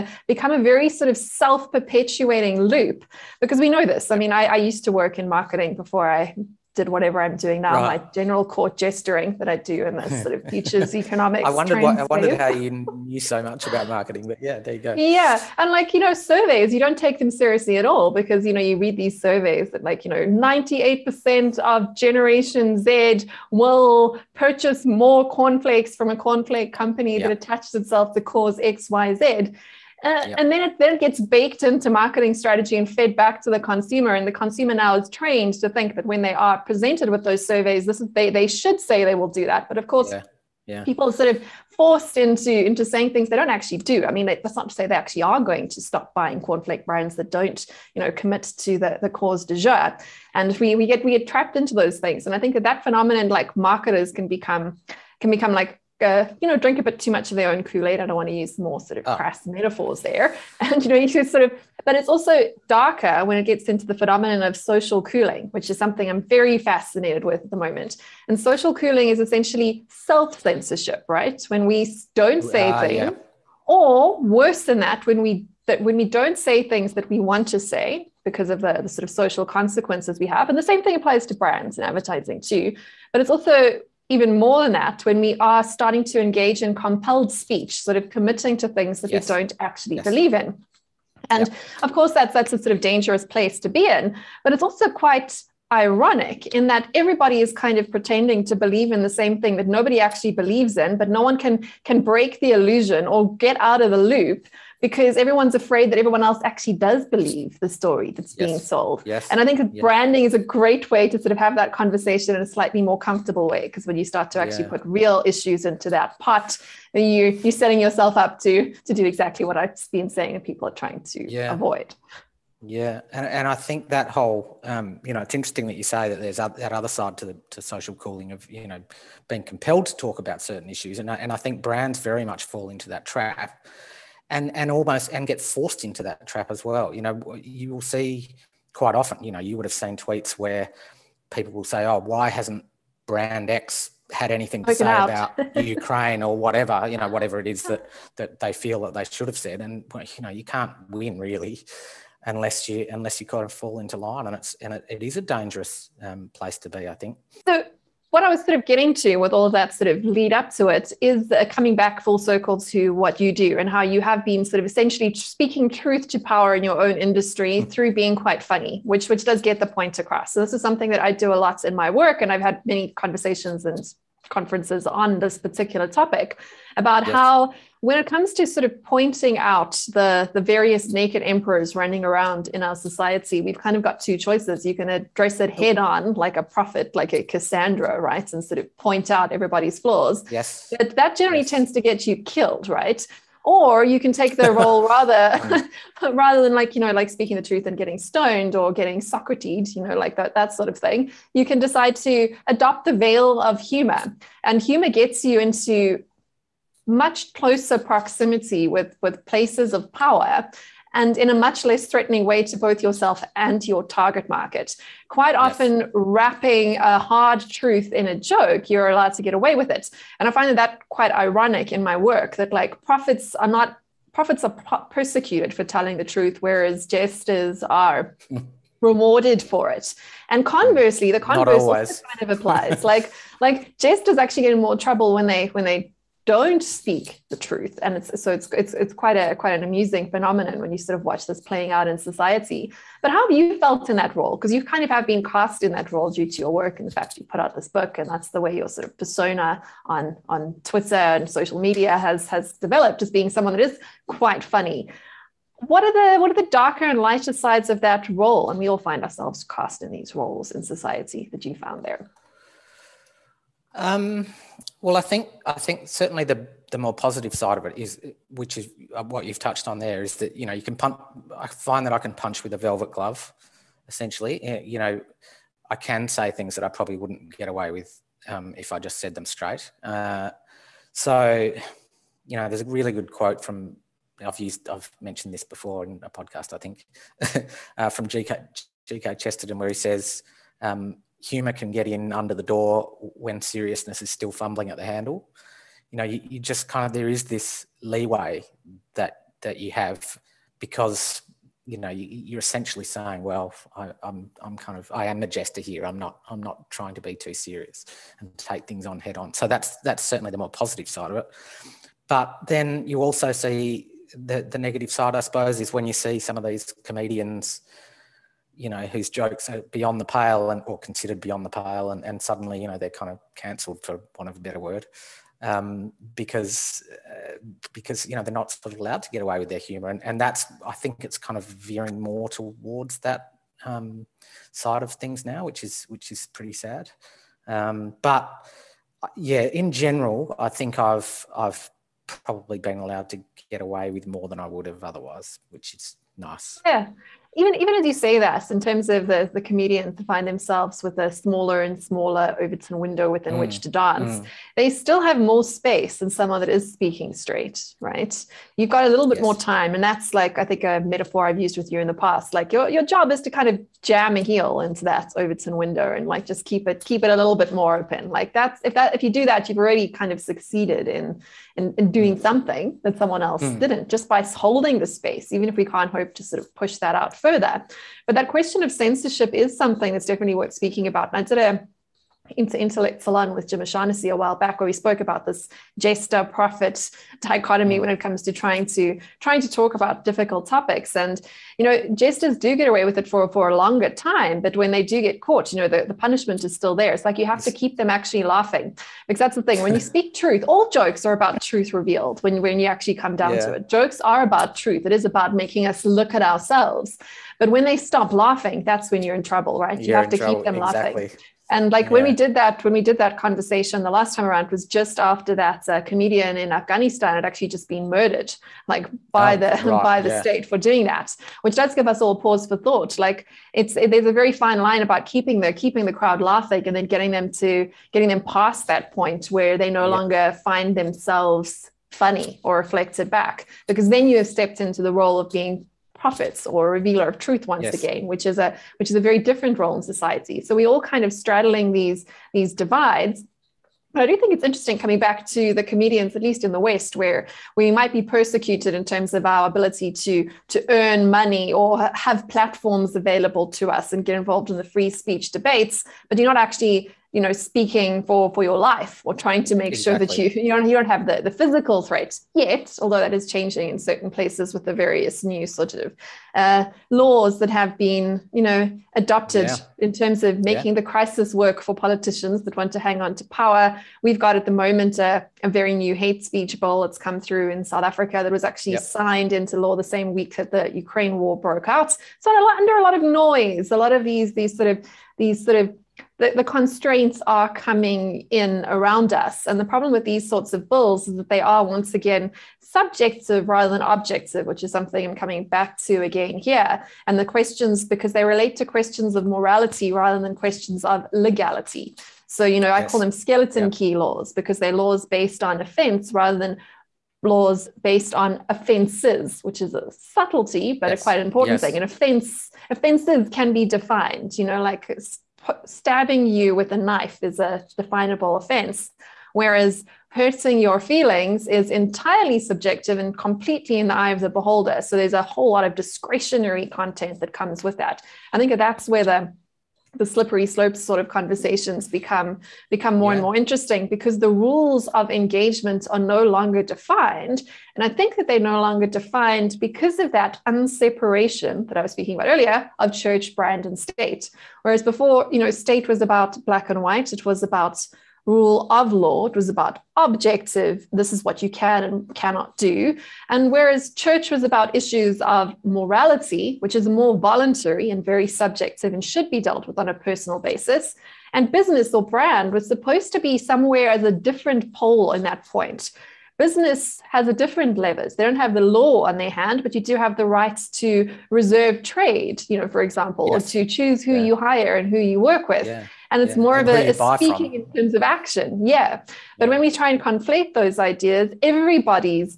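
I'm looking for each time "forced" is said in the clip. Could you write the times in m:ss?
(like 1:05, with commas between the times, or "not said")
0:41, 2:15.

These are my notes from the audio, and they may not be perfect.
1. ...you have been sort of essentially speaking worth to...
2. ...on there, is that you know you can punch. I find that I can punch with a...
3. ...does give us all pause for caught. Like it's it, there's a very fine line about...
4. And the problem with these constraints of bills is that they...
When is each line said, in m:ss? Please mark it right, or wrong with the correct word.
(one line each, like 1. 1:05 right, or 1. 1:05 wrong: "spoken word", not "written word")
1. 2:43 wrong: "truth", not "worth"
2. 4:29 right
3. 7:01 wrong: "thought", not "caught"
4. 8:09 wrong: "sorts", not "constraints".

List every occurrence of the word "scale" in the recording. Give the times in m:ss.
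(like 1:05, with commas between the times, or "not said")
not said.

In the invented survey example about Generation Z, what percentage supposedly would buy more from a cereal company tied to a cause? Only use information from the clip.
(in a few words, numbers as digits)
98%.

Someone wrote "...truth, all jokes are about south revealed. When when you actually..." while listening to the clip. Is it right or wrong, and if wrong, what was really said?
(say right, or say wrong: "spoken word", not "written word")
wrong: "truth", not "south".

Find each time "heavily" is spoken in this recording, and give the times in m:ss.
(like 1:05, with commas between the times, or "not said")
not said.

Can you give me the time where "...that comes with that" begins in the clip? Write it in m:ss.
8:47.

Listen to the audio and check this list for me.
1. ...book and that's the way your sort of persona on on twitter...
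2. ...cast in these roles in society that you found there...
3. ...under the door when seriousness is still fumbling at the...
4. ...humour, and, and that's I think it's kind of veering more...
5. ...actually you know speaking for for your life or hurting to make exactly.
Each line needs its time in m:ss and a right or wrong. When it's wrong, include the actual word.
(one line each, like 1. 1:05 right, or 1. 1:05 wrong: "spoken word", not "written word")
1. 4:07 right
2. 4:19 right
3. 4:52 right
4. 5:29 right
5. 7:36 wrong: "trying", not "hurting".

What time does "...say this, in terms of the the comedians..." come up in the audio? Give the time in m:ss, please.
5:47.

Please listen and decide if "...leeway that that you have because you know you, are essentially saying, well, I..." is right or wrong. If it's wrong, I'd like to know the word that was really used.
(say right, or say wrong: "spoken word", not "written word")
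right.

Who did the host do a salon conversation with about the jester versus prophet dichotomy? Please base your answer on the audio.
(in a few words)
Jim O'Shaughnessy.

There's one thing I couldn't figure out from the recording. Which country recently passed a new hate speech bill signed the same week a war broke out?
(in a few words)
South Africa.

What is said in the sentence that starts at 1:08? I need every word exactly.
And social cooling is essentially self censorship, right?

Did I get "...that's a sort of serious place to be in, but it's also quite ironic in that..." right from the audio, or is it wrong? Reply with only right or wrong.
wrong.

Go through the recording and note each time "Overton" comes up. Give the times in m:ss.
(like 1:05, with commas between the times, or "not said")
5:52, 6:05.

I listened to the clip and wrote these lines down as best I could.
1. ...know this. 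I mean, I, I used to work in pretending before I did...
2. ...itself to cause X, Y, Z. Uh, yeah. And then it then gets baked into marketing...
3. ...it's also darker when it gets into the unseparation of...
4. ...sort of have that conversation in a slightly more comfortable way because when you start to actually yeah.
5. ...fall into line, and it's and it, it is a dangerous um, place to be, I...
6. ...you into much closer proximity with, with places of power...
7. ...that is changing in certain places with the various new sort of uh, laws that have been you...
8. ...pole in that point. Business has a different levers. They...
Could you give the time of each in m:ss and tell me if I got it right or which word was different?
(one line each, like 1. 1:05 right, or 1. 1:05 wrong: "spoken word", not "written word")
1. 0:03 wrong: "marketing", not "pretending"
2. 0:27 right
3. 1:01 wrong: "phenomenon", not "unseparation"
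4. 1:51 right
5. 2:33 right
6. 3:25 right
7. 7:42 right
8. 9:24 right.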